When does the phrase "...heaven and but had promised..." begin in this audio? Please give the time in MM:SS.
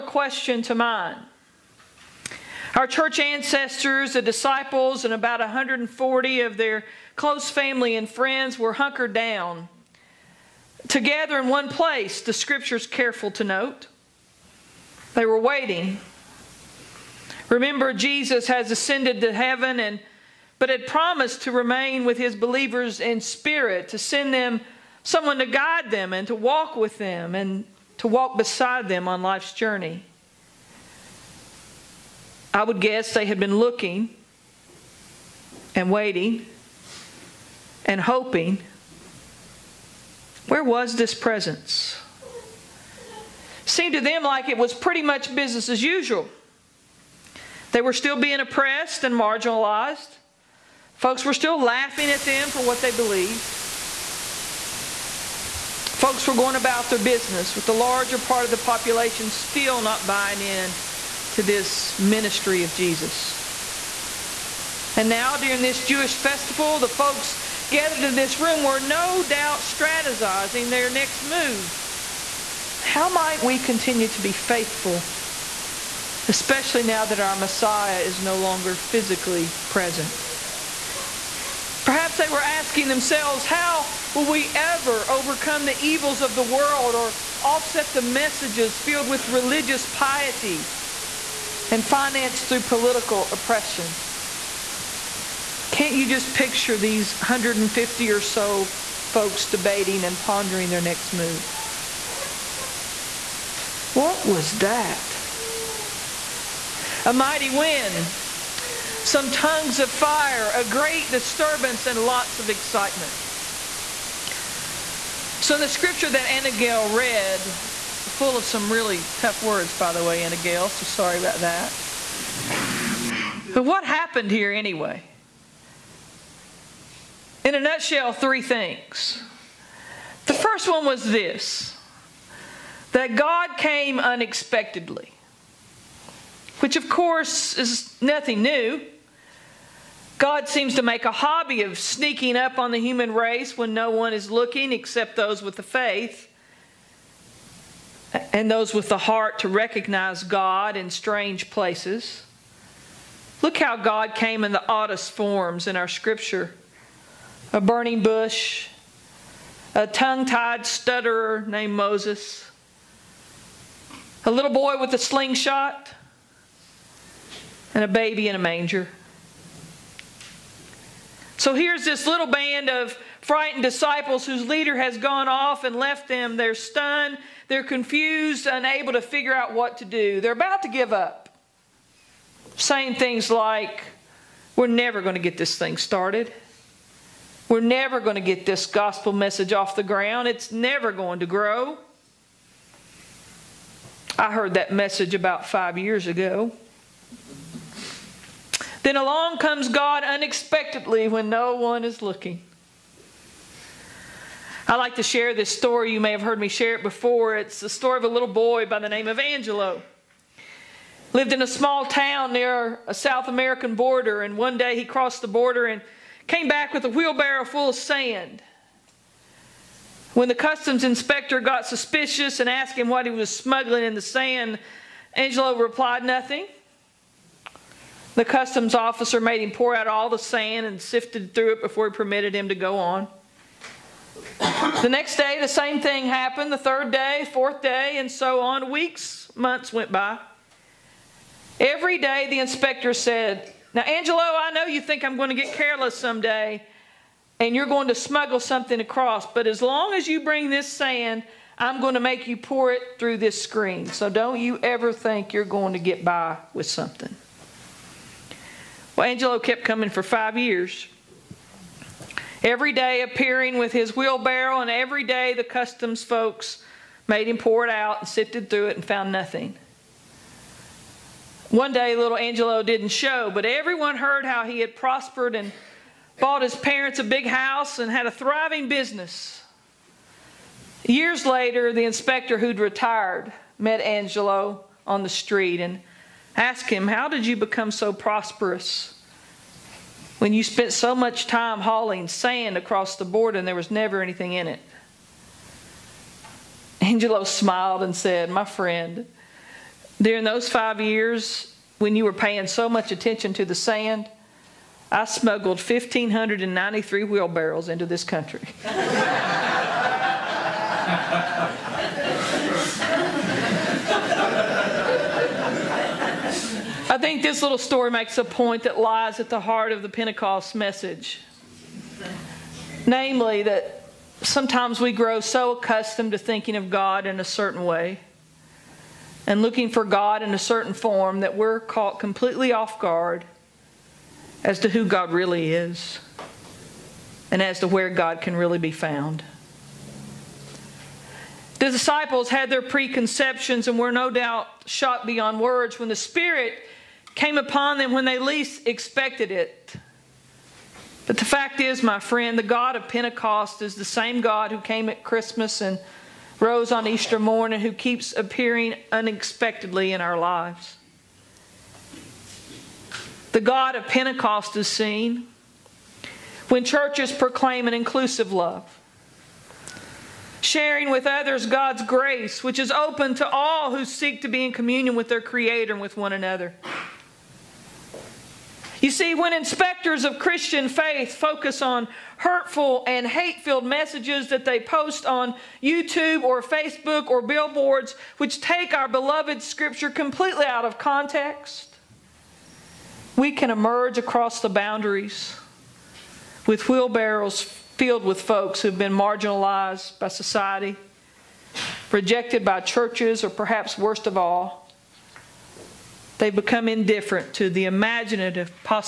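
00:19.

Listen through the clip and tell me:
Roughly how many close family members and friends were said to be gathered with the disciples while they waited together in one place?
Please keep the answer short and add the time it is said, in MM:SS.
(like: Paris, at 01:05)
140, at 00:05.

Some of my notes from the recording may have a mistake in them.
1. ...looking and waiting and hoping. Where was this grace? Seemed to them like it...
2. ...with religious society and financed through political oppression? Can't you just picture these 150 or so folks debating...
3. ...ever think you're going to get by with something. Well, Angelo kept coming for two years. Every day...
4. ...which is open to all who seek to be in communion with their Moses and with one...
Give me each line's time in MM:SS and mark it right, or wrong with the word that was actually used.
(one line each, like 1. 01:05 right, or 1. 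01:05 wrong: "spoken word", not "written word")
1. 00:33 wrong: "presence", not "grace"
2. 01:29 wrong: "piety", not "society"
3. 04:14 wrong: "five", not "two"
4. 06:12 wrong: "Creator", not "Moses".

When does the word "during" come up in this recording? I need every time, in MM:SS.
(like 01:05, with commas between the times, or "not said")
01:05, 04:59.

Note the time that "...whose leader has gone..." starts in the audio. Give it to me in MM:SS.
02:54.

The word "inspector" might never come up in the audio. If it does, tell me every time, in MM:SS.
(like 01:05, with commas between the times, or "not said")
03:40, 04:02, 04:41, 06:19.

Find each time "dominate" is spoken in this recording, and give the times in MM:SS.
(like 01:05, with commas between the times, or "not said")
not said.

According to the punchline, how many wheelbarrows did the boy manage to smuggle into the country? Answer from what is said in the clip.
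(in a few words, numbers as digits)
1,593.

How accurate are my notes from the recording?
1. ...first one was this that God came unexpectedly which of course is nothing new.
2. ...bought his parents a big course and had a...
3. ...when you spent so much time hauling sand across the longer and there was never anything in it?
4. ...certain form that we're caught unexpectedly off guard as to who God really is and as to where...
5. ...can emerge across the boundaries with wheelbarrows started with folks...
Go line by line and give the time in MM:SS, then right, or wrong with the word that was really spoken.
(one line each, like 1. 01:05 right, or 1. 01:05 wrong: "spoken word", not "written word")
1. 02:10 right
2. 04:36 wrong: "house", not "course"
3. 04:50 wrong: "border", not "longer"
4. 05:30 wrong: "completely", not "unexpectedly"
5. 06:33 wrong: "filled", not "started".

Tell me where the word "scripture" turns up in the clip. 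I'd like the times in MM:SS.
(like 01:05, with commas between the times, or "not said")
00:12, 01:55, 02:35, 06:29.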